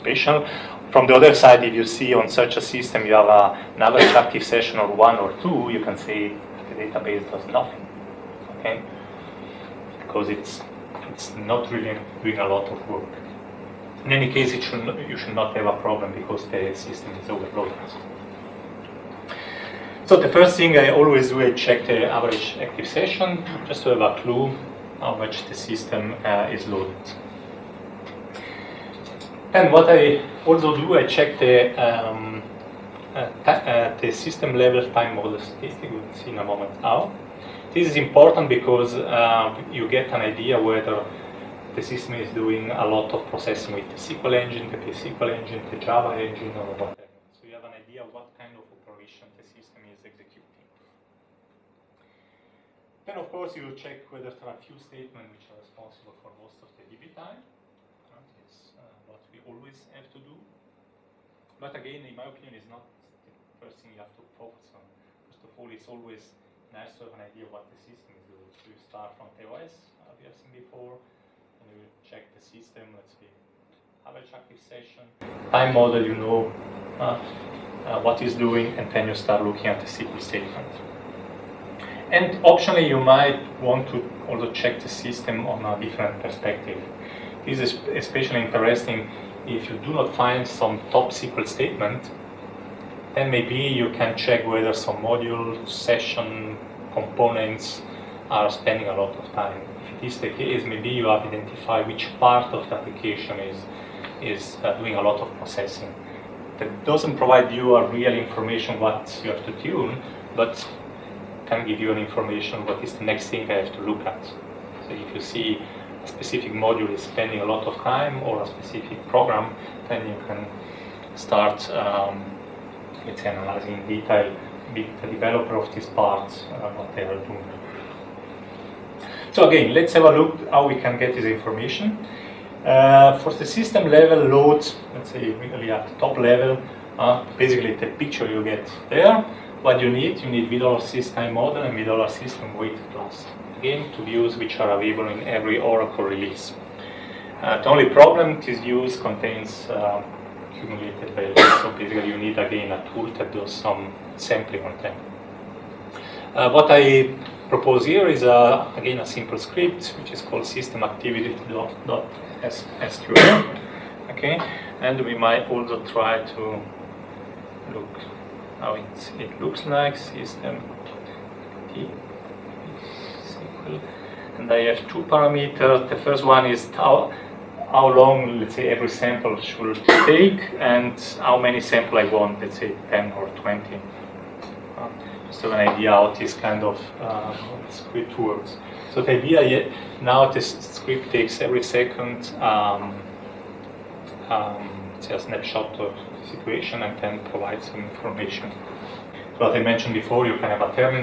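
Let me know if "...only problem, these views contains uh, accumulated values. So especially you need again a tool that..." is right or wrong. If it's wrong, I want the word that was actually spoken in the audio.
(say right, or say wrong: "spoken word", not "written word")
wrong: "basically", not "especially".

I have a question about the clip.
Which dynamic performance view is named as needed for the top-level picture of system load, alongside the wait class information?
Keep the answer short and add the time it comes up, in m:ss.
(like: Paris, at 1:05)
V$SYS_TIME_MODEL, at 2:20.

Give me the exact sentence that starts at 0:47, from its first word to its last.
So you have an idea what kind of operation the system is executing.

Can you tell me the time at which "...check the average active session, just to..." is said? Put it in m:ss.
0:21.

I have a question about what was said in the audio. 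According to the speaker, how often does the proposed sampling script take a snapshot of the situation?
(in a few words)
Every second.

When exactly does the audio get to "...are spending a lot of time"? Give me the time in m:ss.
1:38.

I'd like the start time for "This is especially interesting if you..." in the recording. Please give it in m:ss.
1:27.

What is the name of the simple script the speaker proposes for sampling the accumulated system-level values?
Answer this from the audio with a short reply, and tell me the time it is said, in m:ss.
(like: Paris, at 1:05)
systemactivity.sql, at 2:40.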